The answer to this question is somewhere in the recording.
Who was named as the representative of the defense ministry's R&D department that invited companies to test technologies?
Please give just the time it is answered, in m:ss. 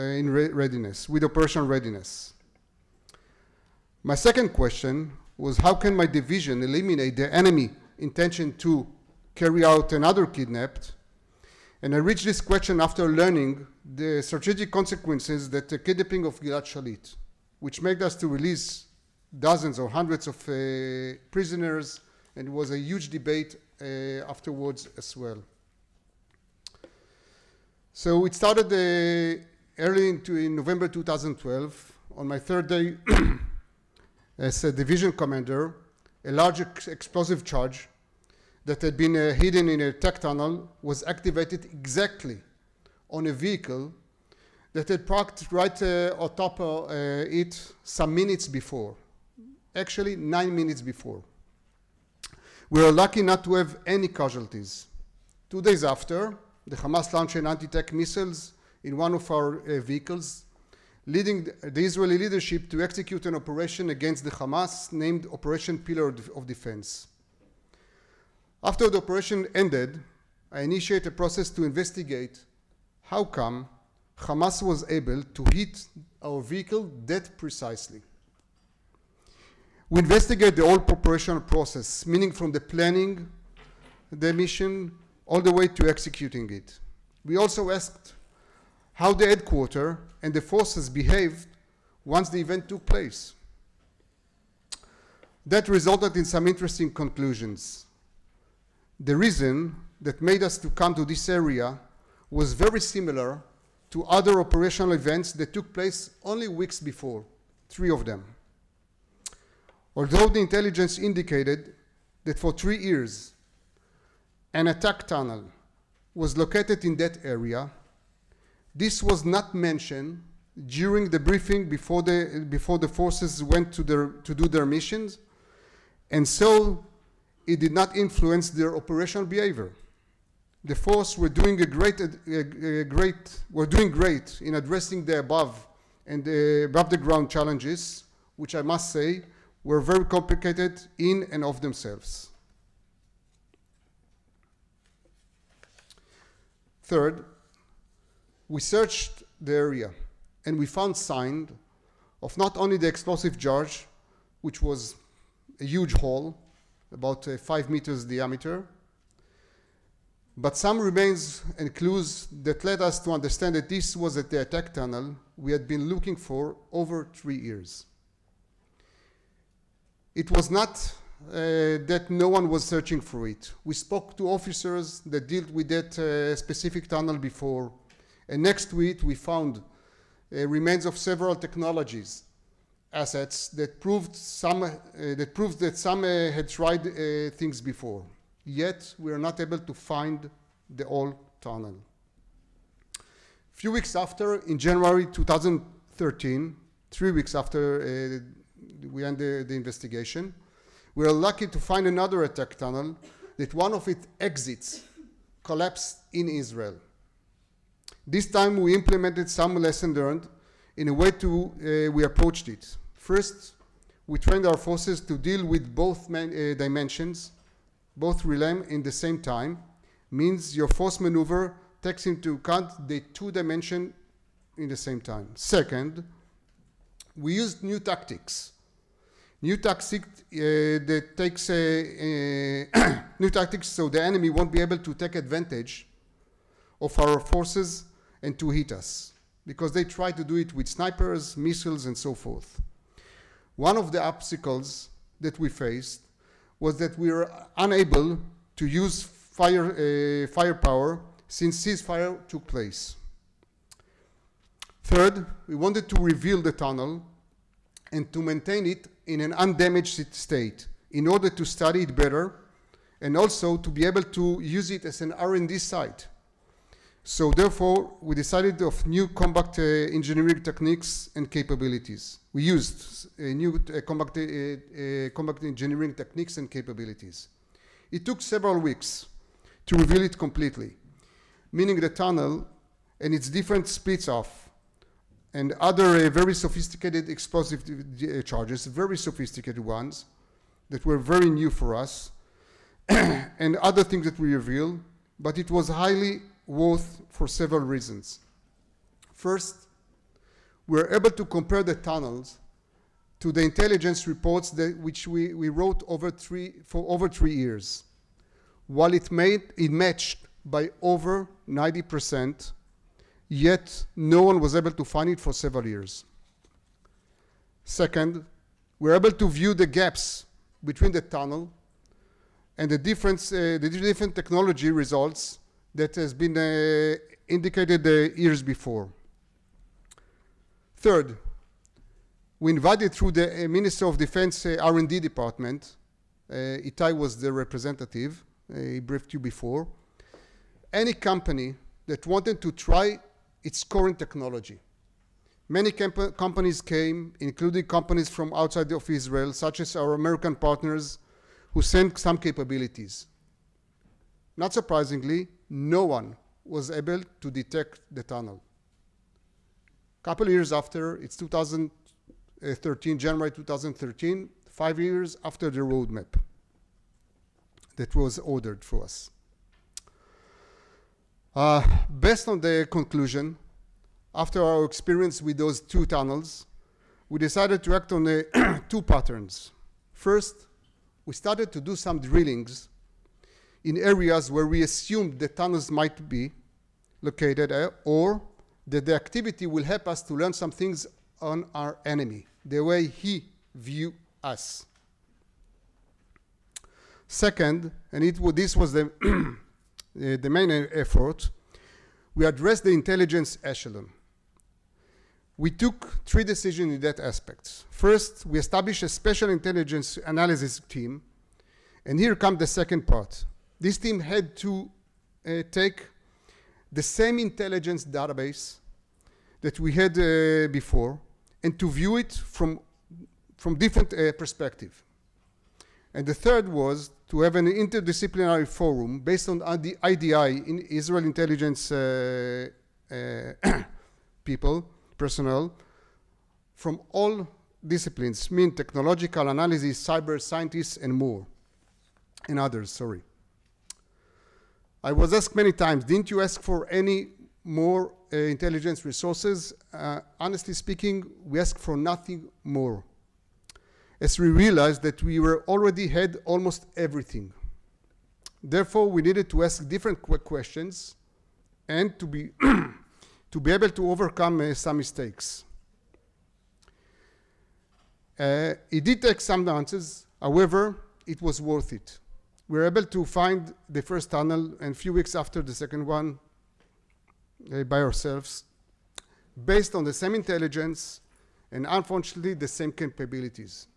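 5:36.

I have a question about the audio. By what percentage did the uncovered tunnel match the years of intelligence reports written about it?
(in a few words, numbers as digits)
90%.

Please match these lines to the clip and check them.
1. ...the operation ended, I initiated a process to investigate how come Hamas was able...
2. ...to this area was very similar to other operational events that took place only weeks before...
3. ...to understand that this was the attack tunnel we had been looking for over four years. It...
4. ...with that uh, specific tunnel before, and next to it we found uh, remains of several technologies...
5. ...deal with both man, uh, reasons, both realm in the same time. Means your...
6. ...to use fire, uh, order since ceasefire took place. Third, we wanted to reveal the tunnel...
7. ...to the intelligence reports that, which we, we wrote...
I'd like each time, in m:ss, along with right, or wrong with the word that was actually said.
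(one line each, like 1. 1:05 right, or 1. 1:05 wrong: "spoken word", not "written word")
1. 1:08 right
2. 1:40 right
3. 2:43 wrong: "three", not "four"
4. 2:55 right
5. 3:35 wrong: "dimensions", not "reasons"
6. 4:08 wrong: "firepower", not "order"
7. 5:03 right.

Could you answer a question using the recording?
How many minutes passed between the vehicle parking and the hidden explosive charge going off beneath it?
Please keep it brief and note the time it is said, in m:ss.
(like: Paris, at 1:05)
9, at 0:50.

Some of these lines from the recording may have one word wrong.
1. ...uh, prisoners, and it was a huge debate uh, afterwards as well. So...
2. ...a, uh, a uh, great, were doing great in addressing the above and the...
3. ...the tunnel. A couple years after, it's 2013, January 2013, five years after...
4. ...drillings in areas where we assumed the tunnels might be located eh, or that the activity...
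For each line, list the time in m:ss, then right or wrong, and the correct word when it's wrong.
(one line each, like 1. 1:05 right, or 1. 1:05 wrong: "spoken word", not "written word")
1. 0:20 right
2. 2:12 right
3. 5:57 right
4. 6:21 right.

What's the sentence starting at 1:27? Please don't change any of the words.
We also asked how the headquarters and the forces behaved once the event took place.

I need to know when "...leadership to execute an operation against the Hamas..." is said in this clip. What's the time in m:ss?
1:02.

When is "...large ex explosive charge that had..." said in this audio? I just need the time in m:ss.
0:36.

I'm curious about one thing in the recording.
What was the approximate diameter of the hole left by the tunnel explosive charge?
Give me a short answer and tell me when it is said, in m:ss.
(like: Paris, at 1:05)
5 meters, at 2:37.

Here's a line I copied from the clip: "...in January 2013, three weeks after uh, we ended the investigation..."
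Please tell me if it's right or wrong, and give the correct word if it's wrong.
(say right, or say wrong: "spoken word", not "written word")
right.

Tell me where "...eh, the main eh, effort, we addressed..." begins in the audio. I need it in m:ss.
6:40.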